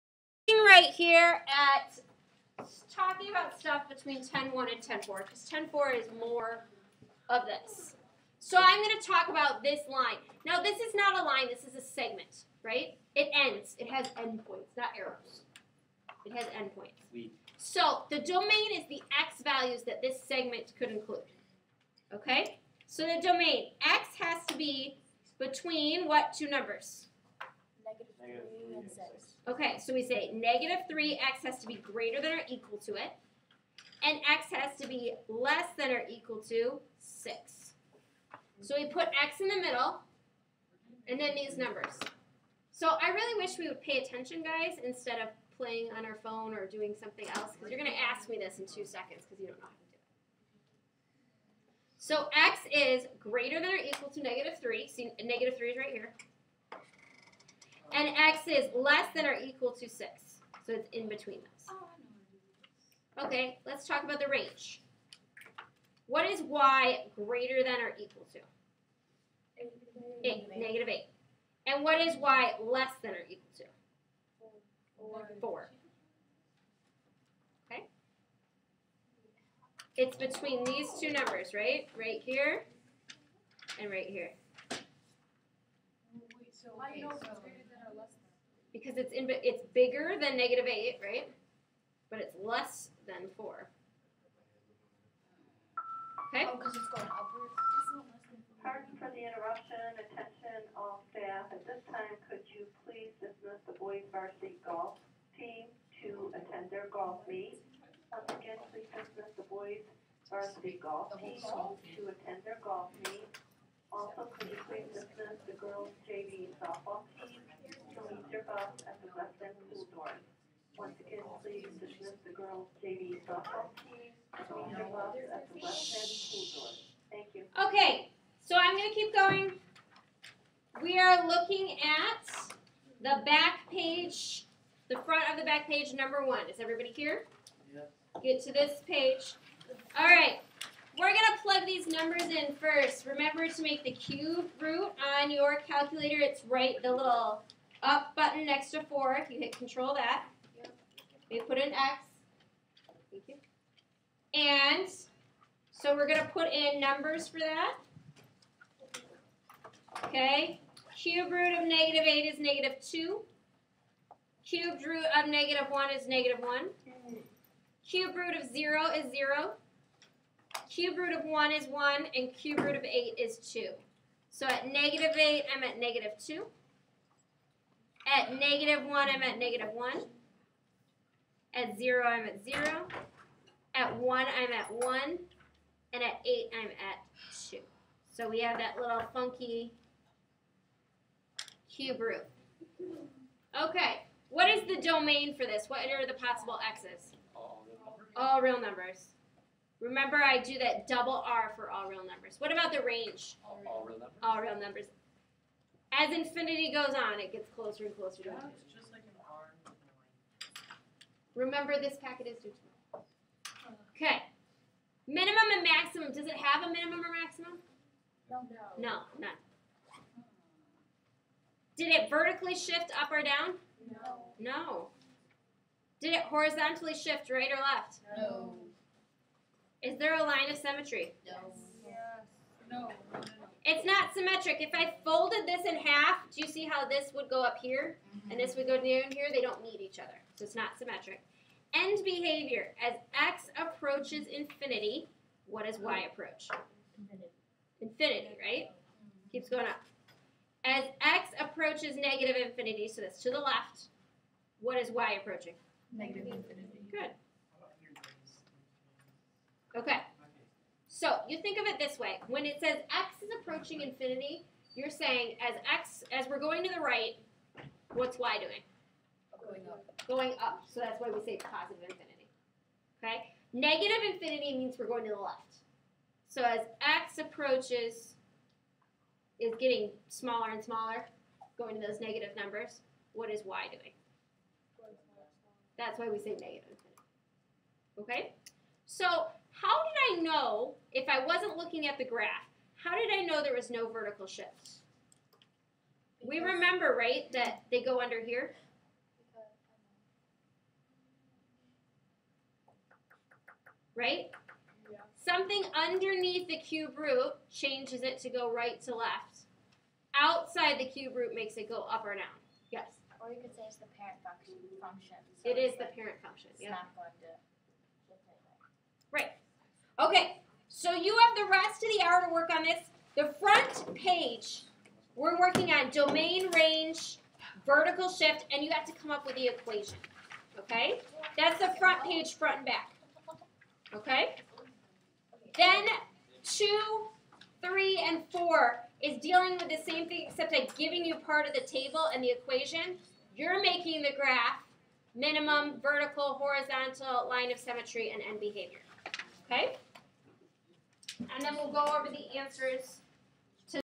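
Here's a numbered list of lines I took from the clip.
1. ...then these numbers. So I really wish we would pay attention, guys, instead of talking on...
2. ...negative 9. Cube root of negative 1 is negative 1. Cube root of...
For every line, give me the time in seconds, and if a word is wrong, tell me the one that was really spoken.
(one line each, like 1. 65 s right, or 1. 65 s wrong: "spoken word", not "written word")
1. 41 s wrong: "playing", not "talking"
2. 162 s wrong: "2", not "9".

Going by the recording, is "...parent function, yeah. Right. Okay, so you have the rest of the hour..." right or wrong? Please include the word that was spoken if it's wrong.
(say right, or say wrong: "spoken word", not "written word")
right.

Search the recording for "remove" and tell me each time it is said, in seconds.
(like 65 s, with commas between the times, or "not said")
118 s, 124 s.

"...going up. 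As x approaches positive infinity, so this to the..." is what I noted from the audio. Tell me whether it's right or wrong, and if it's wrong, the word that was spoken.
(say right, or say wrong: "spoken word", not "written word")
wrong: "negative", not "positive".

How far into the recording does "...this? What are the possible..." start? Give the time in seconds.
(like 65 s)
195 s.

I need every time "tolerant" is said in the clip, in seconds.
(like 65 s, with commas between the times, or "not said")
not said.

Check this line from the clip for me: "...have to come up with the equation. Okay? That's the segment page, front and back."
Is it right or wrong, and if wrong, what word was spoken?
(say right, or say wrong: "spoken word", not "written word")
wrong: "front", not "segment".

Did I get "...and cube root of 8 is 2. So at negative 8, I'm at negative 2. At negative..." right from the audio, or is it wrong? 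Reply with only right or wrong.
right.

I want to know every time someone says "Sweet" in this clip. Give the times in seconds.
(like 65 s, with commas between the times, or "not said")
17 s.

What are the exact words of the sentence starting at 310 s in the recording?
Outside the cube root makes it go up or down.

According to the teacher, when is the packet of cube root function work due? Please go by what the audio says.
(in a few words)
tomorrow.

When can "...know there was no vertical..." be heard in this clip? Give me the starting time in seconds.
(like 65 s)
293 s.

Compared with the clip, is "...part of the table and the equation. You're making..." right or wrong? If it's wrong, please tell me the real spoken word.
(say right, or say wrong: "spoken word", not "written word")
right.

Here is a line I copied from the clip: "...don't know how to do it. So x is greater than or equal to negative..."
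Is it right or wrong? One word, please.
right.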